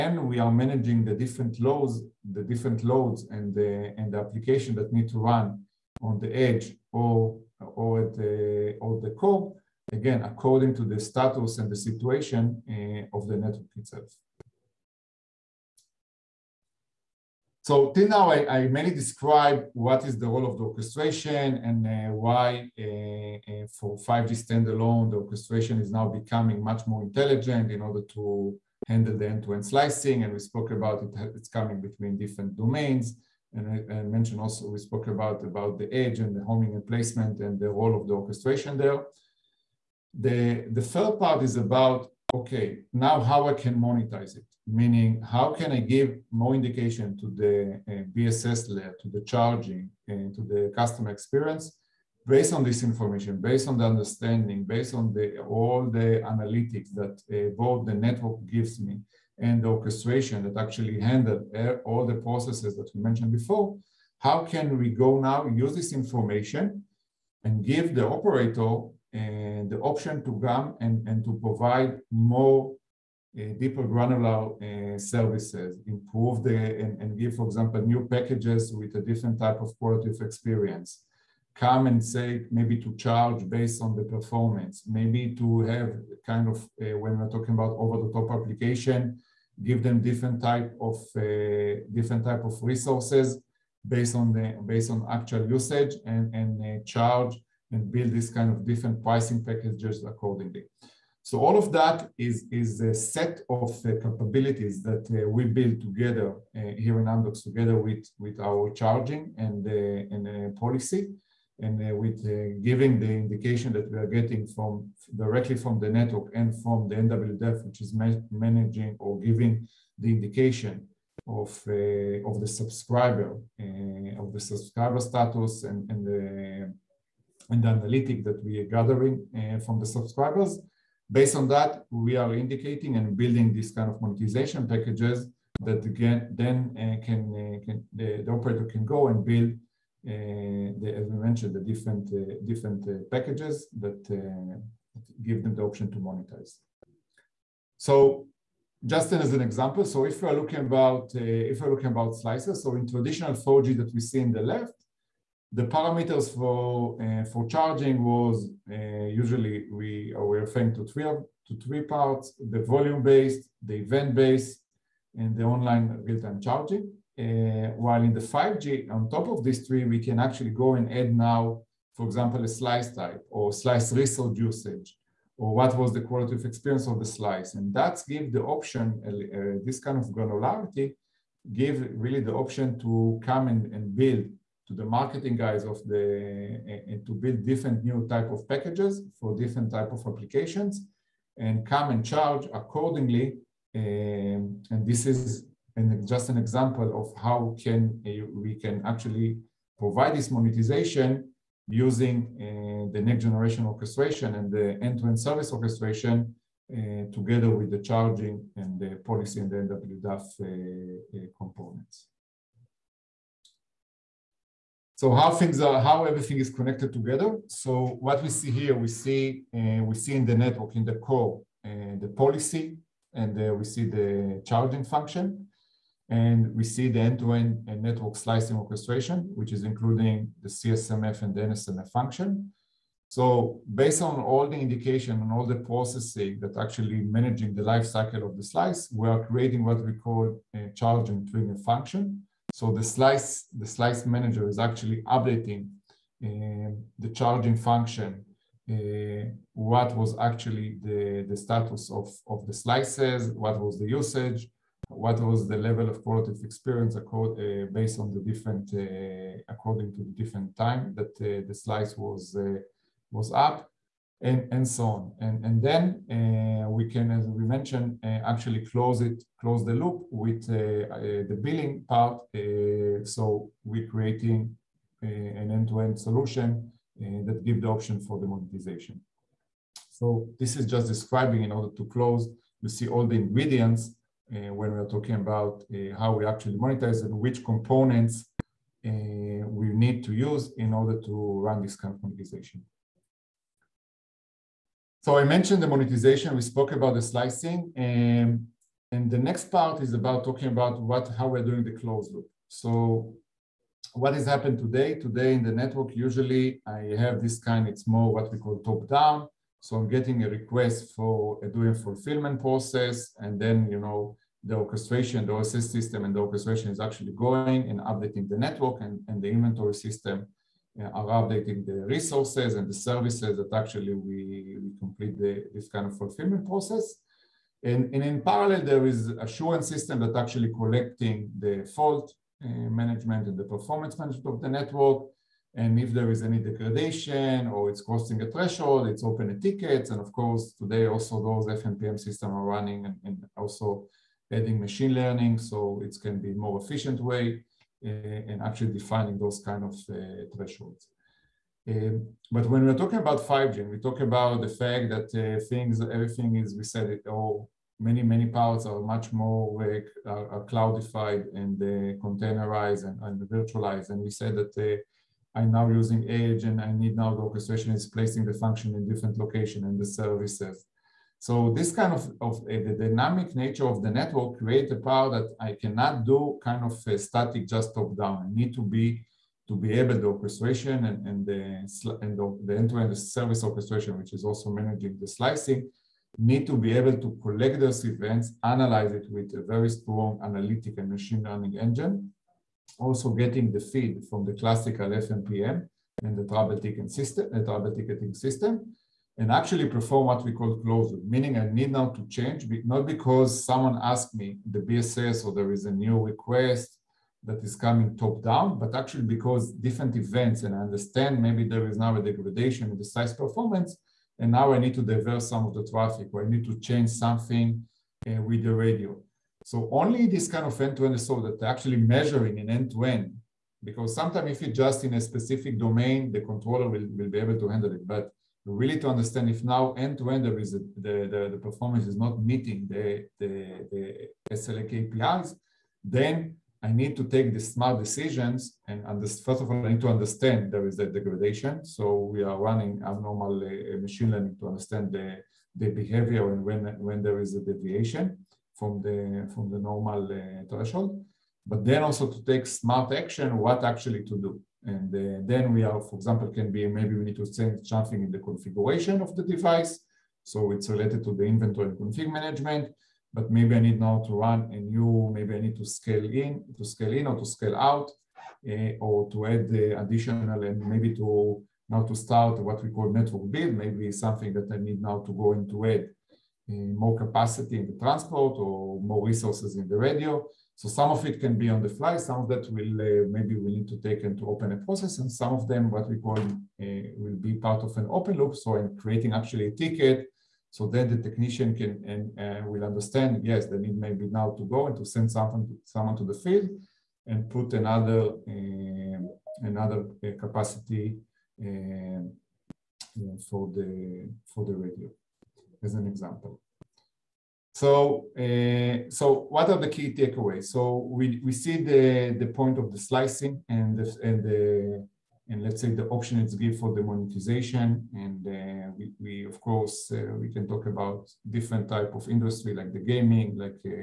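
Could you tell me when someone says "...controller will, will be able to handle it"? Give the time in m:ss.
7:06.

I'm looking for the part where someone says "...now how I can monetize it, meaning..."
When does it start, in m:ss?
0:43.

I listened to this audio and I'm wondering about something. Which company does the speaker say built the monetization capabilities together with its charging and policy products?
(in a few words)
Amdocs.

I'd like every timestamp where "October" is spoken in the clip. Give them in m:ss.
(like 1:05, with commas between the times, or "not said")
not said.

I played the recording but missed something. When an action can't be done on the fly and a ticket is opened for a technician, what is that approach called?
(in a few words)
open loop.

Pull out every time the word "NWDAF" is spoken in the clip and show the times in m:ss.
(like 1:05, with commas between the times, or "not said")
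1:56, 3:29.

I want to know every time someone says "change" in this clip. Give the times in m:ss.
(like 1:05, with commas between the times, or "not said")
6:42, 6:56, 7:37.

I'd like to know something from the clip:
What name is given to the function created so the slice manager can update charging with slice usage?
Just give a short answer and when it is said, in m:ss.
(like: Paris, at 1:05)
charge and trigger function, at 4:00.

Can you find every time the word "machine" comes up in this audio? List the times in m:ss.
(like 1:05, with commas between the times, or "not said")
5:44, 6:30, 7:23.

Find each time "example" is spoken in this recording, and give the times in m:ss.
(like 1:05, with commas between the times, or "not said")
1:17, 2:29, 2:52, 3:16, 7:35, 8:25.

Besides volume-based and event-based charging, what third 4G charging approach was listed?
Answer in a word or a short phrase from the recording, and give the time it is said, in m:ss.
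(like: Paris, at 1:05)
online real-time charging, at 2:45.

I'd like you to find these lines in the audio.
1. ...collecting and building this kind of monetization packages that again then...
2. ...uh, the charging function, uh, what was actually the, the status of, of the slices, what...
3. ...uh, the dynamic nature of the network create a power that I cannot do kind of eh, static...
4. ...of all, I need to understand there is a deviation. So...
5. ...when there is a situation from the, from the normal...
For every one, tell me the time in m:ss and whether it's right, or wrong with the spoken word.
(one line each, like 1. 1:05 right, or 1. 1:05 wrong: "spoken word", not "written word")
1. 2:12 wrong: "indicating", not "collecting"
2. 4:06 right
3. 6:12 right
4. 7:19 wrong: "degradation", not "deviation"
5. 7:26 wrong: "deviation", not "situation".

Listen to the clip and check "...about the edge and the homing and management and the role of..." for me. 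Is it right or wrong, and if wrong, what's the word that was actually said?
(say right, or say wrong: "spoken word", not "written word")
wrong: "placement", not "management".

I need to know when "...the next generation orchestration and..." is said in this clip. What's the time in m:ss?
3:22.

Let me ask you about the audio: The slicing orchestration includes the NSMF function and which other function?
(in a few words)
CSMF.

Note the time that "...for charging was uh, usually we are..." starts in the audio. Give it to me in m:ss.
2:37.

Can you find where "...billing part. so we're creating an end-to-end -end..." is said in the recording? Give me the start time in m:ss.
4:31.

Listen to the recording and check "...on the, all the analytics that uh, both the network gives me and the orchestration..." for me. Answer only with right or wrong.
right.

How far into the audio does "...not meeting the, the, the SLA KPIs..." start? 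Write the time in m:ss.
7:11.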